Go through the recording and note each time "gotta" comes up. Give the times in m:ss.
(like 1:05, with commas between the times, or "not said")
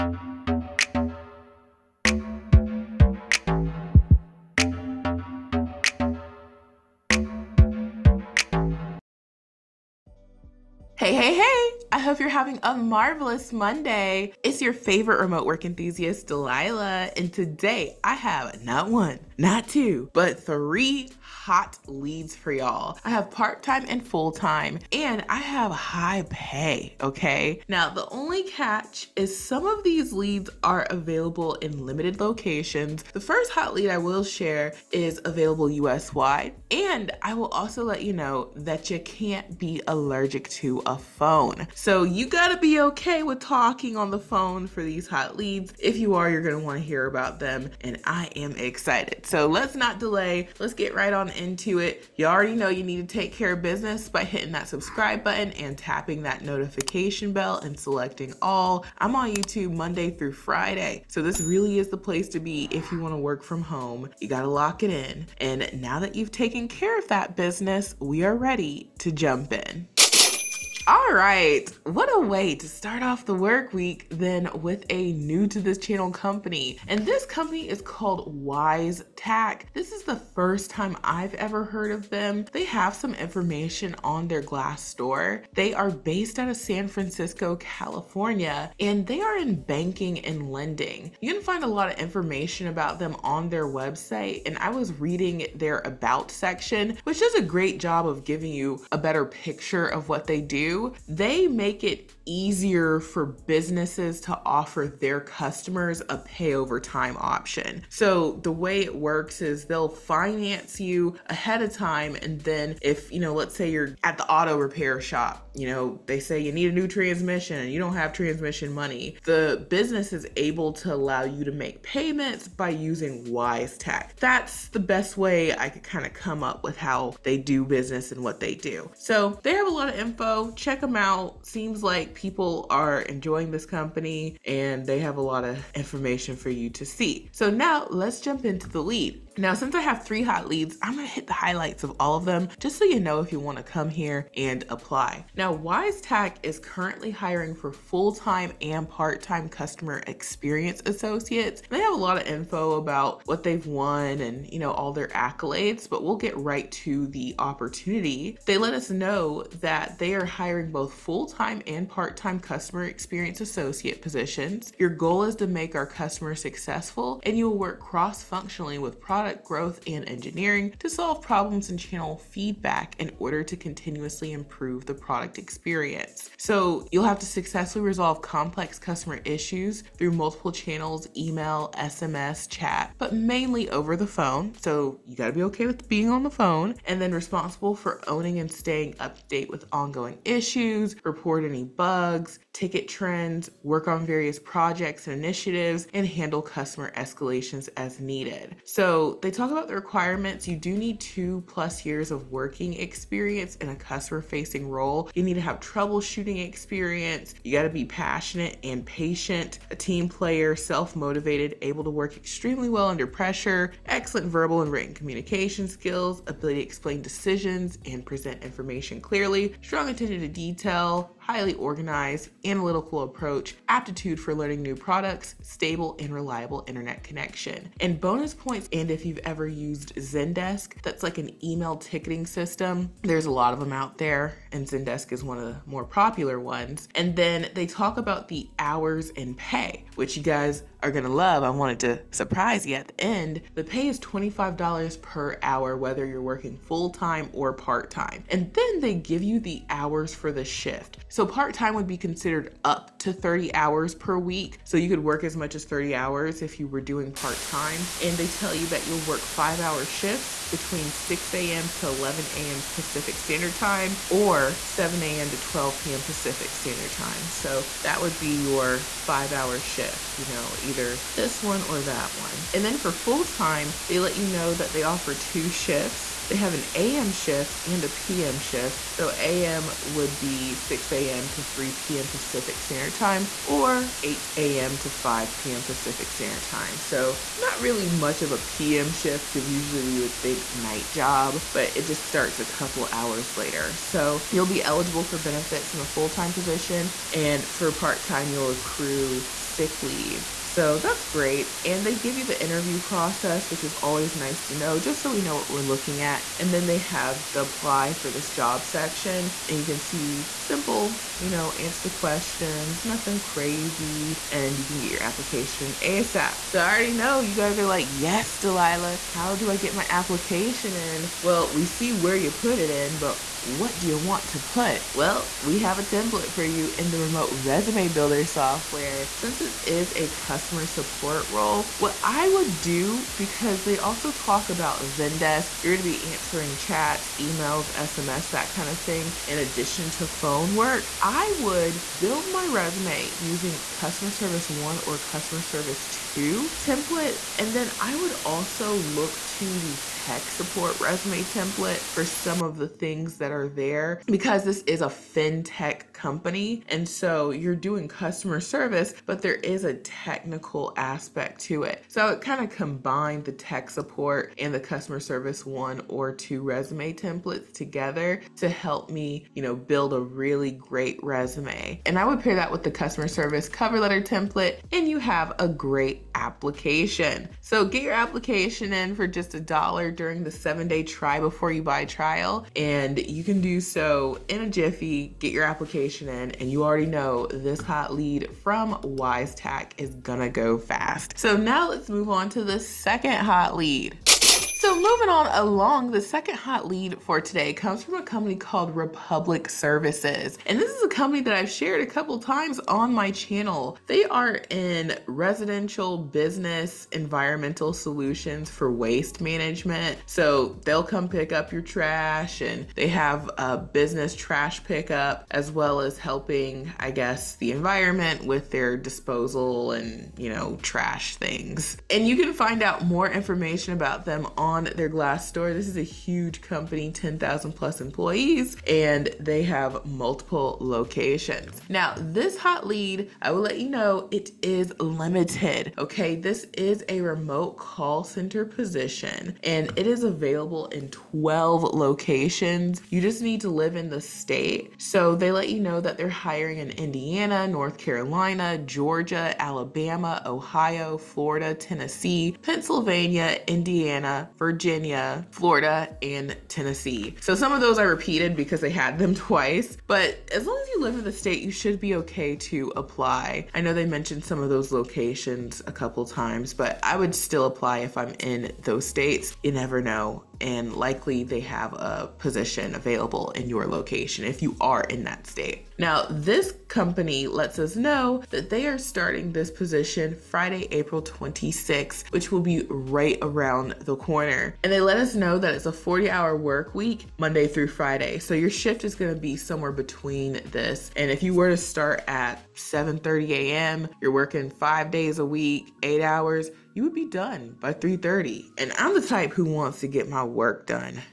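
0:42, 1:04, 3:05.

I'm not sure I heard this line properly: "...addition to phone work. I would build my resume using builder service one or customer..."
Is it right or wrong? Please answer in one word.
wrong.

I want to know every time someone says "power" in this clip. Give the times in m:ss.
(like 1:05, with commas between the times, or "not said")
not said.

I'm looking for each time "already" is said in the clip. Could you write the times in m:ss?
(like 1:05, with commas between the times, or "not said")
0:52, 5:16, 6:26.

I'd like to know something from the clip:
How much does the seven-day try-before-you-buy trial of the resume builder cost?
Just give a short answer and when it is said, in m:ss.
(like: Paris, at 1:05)
$1, at 6:19.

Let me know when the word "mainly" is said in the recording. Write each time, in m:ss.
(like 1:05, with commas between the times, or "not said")
3:03.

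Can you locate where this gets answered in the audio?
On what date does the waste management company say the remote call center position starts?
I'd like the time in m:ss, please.
8:00.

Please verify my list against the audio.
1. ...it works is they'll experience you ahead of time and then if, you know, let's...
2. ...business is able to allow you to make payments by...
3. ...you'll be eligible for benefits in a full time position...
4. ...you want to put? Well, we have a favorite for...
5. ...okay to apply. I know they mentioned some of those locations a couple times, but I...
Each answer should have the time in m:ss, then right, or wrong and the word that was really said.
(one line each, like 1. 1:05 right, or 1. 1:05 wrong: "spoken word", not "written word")
1. 1:48 wrong: "finance", not "experience"
2. 1:59 right
3. 4:54 right
4. 5:23 wrong: "template", not "favorite"
5. 7:41 right.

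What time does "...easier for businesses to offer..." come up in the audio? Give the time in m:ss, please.
1:42.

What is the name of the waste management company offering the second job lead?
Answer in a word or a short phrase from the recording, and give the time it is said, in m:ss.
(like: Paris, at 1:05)
Republic Services, at 6:38.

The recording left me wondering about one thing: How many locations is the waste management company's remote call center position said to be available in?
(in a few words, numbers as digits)
12.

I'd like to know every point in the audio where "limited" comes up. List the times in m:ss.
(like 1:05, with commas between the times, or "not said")
0:31, 7:14.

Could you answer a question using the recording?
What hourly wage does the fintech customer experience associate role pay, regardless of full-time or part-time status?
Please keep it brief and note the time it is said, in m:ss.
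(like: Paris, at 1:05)
$25, at 4:04.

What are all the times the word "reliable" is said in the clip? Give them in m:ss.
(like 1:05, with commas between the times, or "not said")
3:46.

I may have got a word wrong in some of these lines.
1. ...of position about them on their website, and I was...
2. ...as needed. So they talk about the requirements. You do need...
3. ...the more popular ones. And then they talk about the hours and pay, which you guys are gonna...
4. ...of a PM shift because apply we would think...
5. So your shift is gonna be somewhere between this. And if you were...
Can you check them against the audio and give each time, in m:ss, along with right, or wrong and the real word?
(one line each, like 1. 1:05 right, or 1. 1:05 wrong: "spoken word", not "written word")
1. 1:31 wrong: "information", not "position"
2. 3:17 right
3. 3:55 right
4. 4:48 wrong: "usually", not "apply"
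5. 8:08 right.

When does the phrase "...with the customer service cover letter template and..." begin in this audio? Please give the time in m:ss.
6:12.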